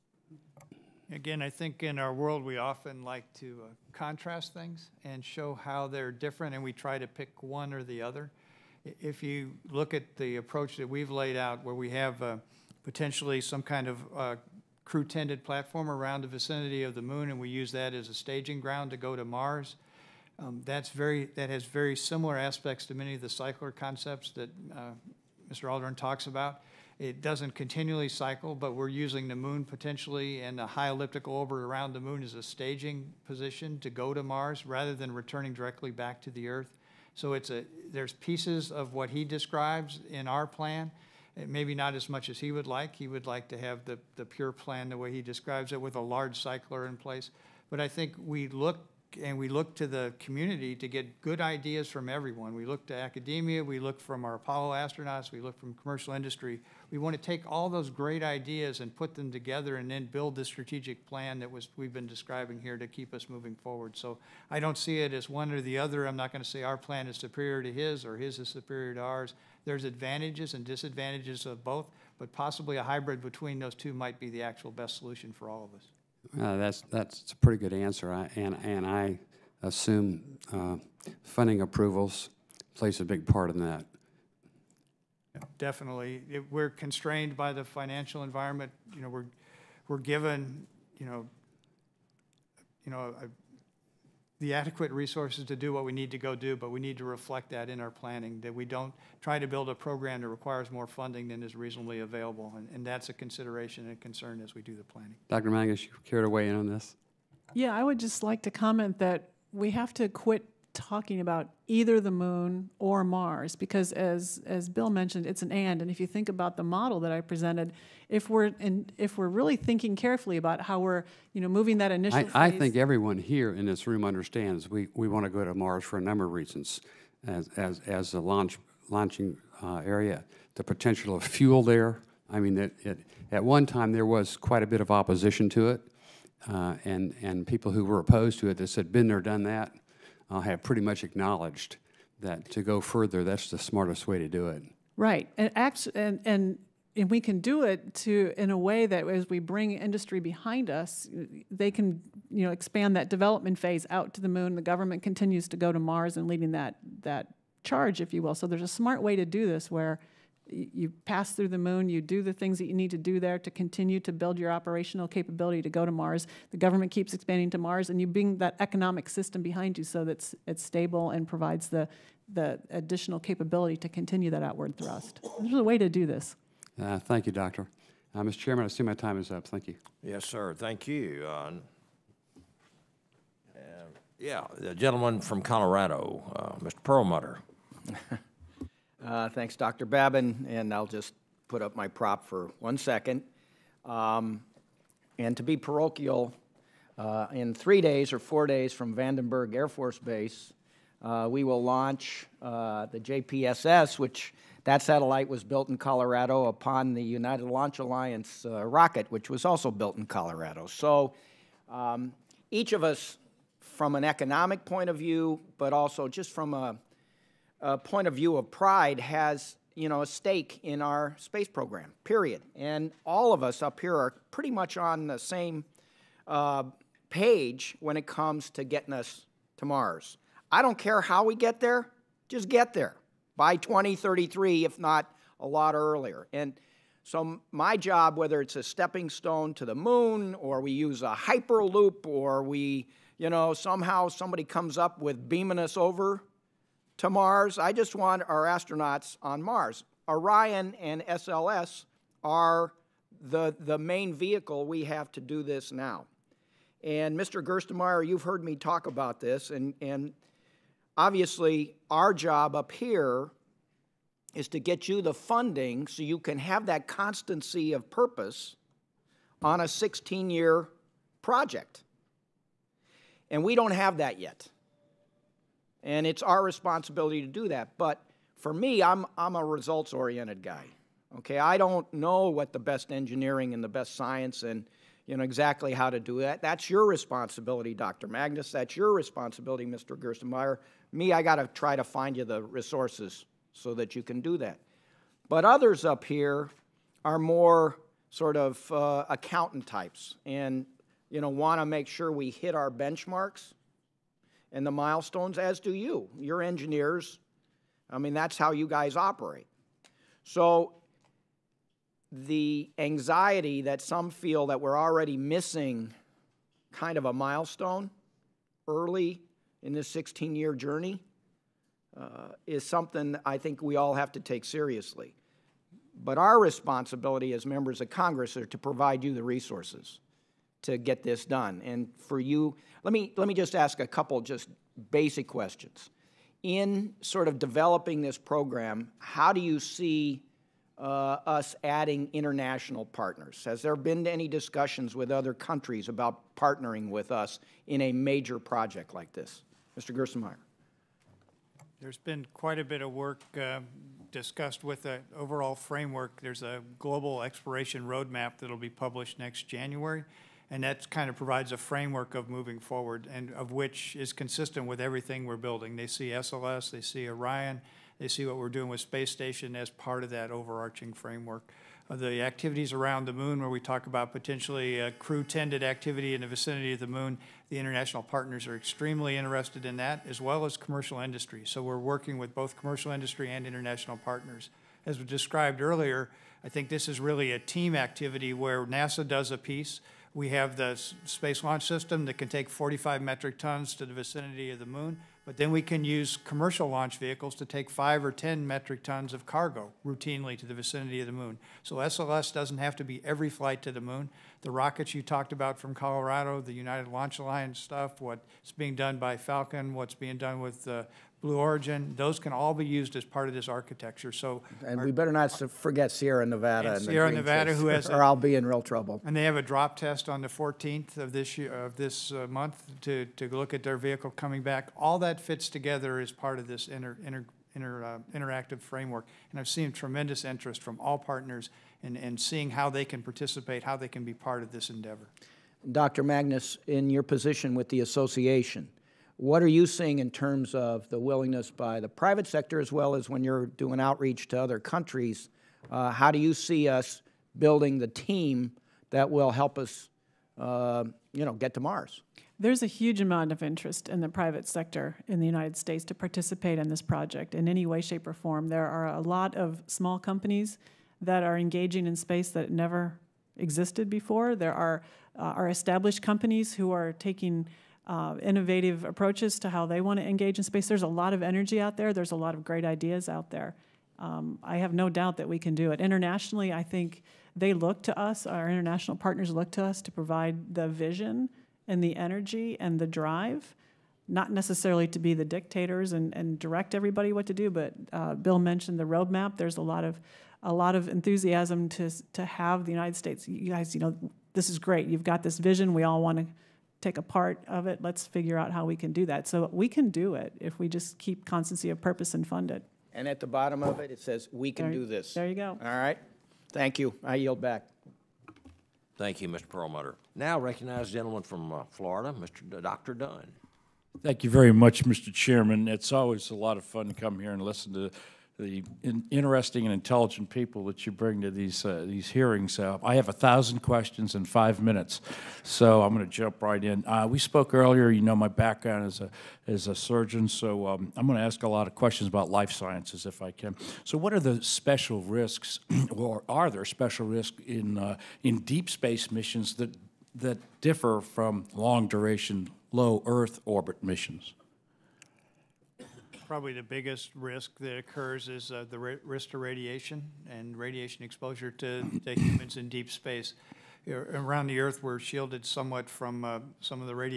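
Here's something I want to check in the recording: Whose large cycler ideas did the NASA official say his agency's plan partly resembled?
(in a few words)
Mr. Aldrin.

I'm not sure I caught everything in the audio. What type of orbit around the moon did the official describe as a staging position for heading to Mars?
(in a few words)
high elliptical orbit.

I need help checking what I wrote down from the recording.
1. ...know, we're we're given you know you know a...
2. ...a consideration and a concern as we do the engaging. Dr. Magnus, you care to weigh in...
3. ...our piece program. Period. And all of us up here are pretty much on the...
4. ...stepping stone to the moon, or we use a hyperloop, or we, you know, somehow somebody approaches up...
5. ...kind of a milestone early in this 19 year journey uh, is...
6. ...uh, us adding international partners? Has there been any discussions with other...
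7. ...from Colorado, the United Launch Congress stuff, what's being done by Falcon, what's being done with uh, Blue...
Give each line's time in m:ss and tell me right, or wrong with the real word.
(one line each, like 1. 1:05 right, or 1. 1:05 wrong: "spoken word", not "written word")
1. 1:29 right
2. 1:43 wrong: "planning", not "engaging"
3. 3:40 wrong: "space", not "piece"
4. 3:58 wrong: "comes", not "approaches"
5. 5:16 wrong: "16", not "19"
6. 5:40 right
7. 6:45 wrong: "Alliance", not "Congress".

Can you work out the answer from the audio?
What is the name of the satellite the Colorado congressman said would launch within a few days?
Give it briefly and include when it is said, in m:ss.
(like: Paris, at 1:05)
JPSS, at 3:22.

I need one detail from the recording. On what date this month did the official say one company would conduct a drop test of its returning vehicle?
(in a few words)
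the 14th.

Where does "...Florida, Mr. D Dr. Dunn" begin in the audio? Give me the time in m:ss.
8:31.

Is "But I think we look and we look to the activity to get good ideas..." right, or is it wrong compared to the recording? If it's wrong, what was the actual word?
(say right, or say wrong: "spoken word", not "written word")
wrong: "community", not "activity".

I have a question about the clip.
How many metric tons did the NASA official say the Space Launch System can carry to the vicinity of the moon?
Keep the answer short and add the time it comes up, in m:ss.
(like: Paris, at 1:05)
45 metric tons, at 6:32.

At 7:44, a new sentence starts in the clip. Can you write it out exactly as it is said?
There are, uh, are established companies who are taking uh, innovative approaches to how they want to engage in space.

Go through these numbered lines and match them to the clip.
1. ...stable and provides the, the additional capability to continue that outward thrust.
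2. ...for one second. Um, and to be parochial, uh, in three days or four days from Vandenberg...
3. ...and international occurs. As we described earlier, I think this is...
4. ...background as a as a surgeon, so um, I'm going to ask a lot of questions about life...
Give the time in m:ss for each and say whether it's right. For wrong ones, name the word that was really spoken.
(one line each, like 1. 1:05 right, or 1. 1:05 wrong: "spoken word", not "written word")
1. 2:50 right
2. 3:12 right
3. 6:23 wrong: "partners", not "occurs"
4. 8:48 right.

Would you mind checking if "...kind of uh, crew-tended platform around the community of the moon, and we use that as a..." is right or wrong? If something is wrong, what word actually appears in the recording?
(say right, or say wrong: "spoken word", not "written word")
wrong: "vicinity", not "community".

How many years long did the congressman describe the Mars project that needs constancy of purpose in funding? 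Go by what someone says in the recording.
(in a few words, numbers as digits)
16.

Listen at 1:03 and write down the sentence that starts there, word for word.
So I don't see it as one or the other.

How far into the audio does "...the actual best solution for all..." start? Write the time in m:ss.
1:14.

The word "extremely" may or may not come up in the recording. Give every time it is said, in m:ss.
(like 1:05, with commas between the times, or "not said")
6:18.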